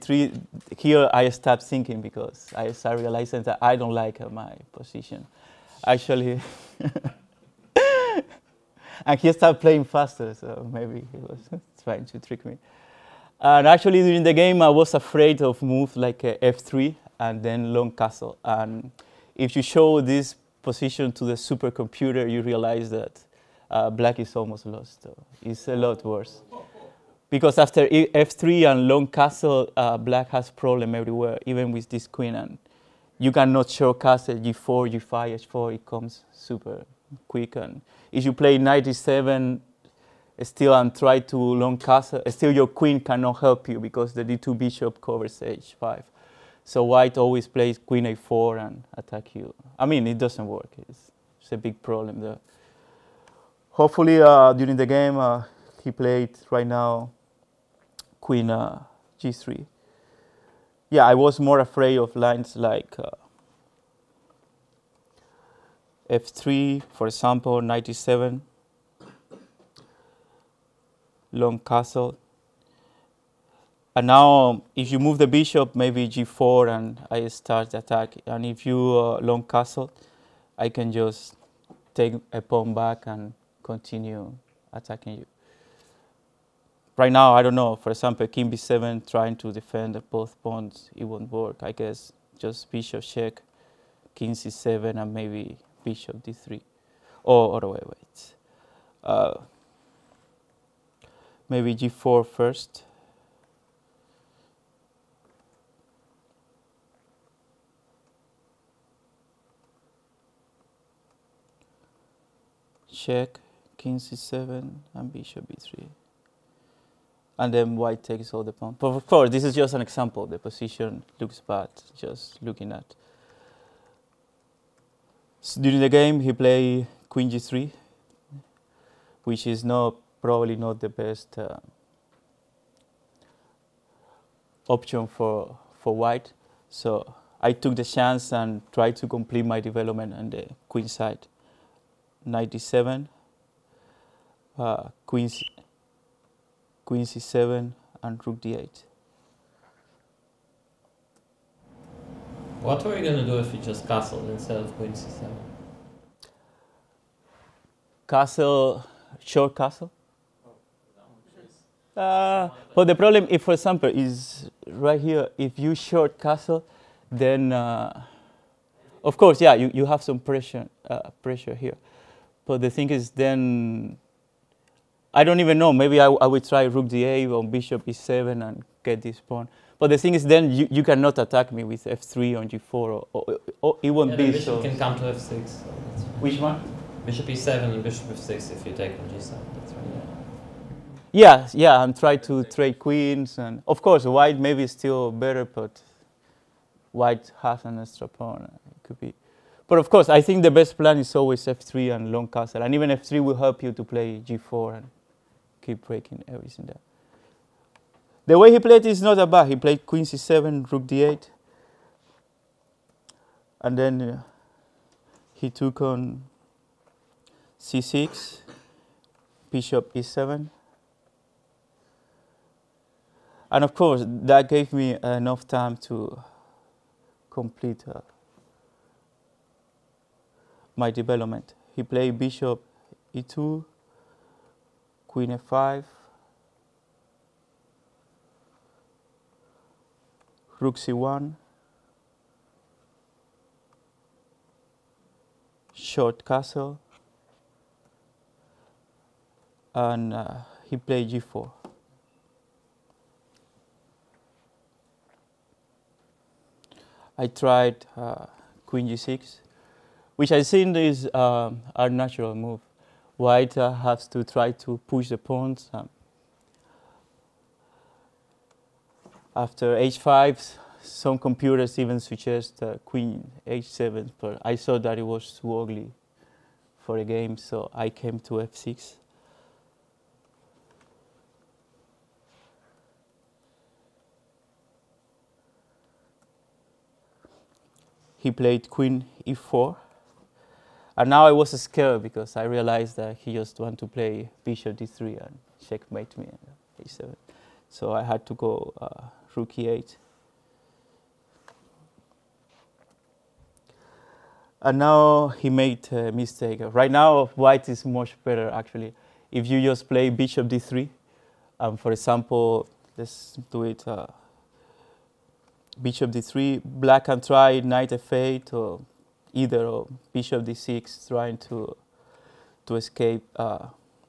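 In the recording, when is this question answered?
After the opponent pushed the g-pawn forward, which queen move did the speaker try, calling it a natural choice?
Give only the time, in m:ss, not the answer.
4:18.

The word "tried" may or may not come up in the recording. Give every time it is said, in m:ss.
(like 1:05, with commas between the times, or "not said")
2:18, 4:17.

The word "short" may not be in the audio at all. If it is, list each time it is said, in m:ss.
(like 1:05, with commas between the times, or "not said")
2:39, 2:45, 4:05.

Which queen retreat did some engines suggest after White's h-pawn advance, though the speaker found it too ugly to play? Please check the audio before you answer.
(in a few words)
queen h7.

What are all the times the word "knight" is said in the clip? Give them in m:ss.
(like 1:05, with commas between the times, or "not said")
0:38, 2:22, 5:17.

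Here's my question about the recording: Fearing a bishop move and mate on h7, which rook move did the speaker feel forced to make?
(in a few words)
rook e8.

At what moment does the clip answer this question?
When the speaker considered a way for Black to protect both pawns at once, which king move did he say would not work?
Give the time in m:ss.
1:28.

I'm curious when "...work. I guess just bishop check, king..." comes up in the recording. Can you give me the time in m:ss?
1:31.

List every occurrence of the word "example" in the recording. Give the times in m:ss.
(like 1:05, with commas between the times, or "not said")
1:07, 1:27, 1:59, 2:43, 5:11.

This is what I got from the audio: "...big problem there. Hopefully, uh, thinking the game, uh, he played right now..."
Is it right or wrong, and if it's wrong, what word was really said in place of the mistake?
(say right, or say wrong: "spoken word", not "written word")
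wrong: "during", not "thinking".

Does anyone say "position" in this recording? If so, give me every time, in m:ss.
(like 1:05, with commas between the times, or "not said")
0:04, 0:20, 2:00.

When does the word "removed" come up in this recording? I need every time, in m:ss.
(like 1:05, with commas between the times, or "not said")
not said.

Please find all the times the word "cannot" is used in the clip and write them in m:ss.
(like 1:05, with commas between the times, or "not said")
0:33, 0:43, 3:00.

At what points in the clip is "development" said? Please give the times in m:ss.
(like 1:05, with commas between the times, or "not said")
2:19, 3:50.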